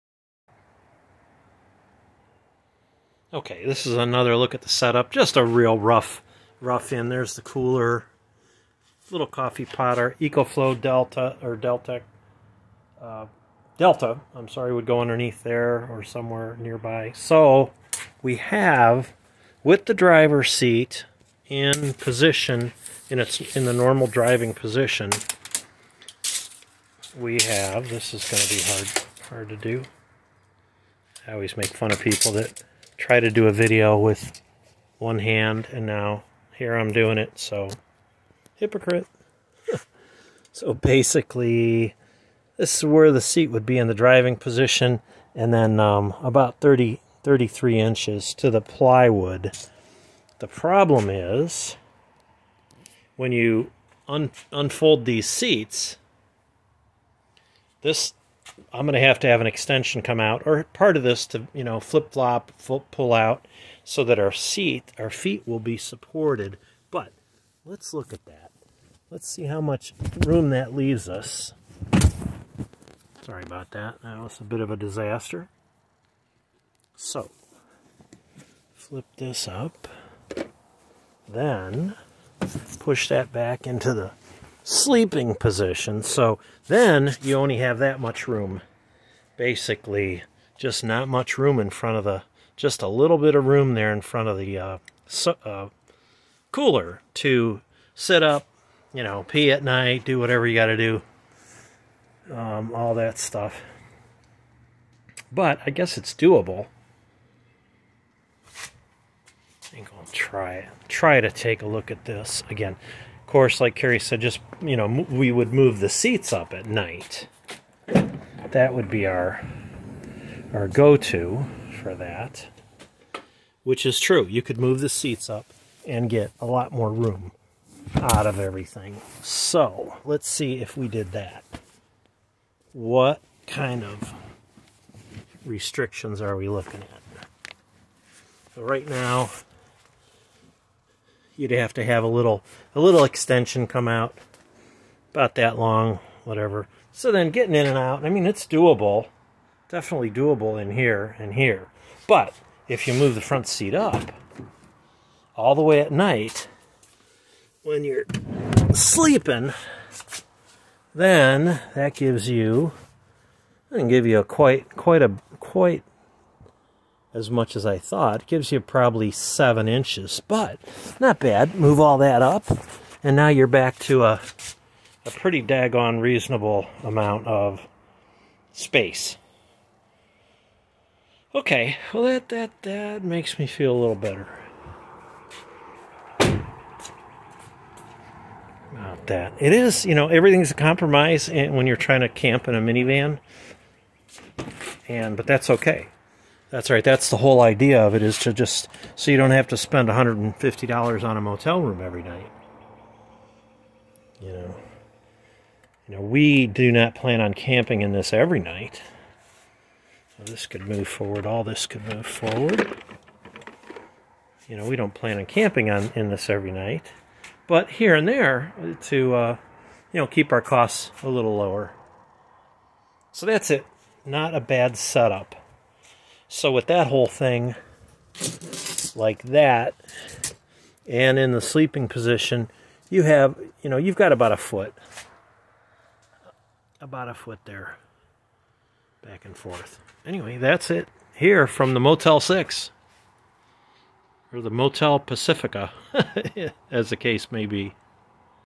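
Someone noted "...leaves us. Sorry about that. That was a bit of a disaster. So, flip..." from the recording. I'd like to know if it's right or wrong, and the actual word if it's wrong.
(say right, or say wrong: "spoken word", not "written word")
right.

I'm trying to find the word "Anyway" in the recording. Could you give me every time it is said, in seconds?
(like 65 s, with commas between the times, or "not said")
240 s.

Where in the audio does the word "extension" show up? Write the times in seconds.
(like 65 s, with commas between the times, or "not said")
59 s, 143 s.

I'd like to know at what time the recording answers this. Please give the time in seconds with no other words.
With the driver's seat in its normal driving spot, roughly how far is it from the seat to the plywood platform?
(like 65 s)
47 s.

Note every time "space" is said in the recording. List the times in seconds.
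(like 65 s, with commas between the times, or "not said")
178 s.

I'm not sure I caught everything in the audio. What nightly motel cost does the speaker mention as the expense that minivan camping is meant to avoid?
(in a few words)
$150.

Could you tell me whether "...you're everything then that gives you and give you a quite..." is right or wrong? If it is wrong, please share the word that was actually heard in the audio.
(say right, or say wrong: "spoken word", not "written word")
wrong: "sleeping", not "everything".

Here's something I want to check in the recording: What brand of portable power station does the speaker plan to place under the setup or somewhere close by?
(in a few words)
EcoFlow.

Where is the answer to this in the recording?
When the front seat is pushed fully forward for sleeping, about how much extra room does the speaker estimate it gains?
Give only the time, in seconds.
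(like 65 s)
169 s.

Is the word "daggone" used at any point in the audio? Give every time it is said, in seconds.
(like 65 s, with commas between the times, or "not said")
175 s.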